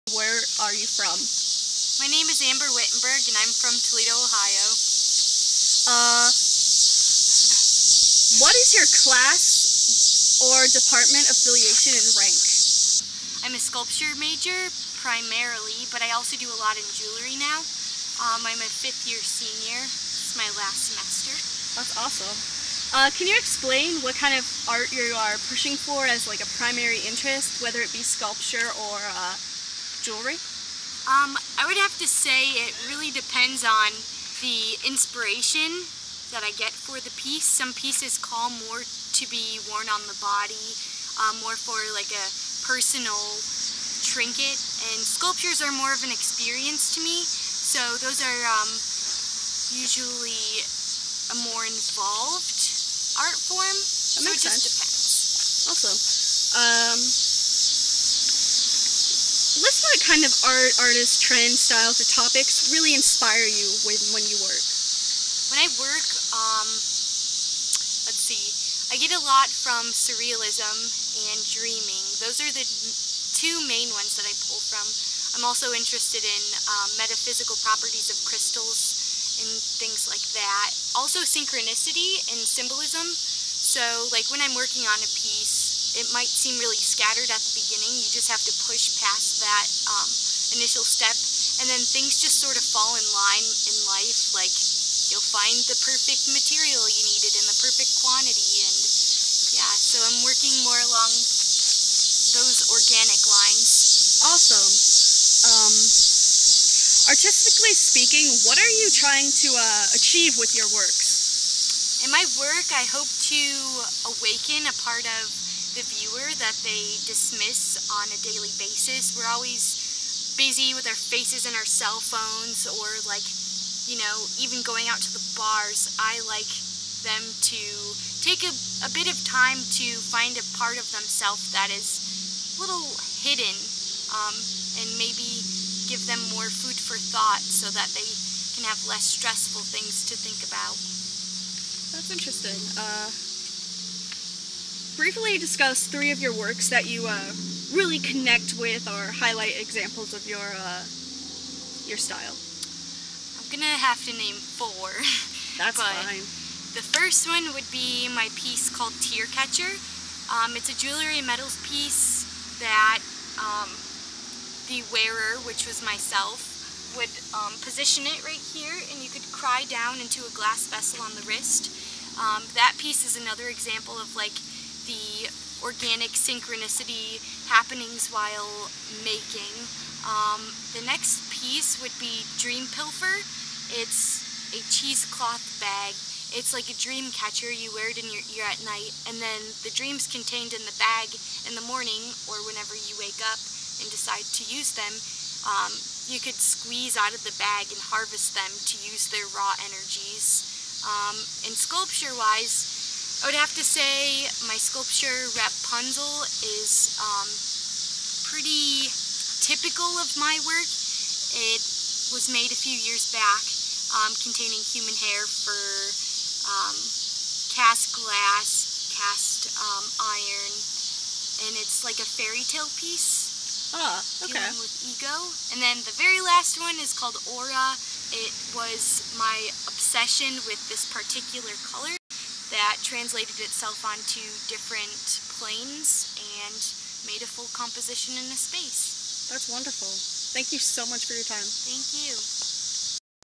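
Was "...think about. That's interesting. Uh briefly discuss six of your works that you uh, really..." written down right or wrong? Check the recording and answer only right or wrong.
wrong.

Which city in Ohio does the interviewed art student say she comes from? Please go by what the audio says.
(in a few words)
Toledo.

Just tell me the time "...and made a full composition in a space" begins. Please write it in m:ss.
3:56.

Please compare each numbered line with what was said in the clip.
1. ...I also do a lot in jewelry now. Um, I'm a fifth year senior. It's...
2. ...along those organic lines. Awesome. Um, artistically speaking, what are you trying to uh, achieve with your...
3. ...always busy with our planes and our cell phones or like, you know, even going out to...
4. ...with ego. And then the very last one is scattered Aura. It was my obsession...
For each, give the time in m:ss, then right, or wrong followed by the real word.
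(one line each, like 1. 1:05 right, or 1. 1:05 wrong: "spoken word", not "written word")
1. 0:16 right
2. 1:40 right
3. 1:59 wrong: "faces", not "planes"
4. 3:44 wrong: "called", not "scattered".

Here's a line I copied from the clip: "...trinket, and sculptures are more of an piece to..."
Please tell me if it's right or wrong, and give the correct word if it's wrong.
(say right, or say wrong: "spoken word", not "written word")
wrong: "experience", not "piece".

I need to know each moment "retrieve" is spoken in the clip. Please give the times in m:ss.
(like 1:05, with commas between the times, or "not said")
not said.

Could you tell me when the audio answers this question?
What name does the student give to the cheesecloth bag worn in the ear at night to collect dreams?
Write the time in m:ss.
3:02.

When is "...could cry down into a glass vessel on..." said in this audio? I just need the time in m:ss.
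2:49.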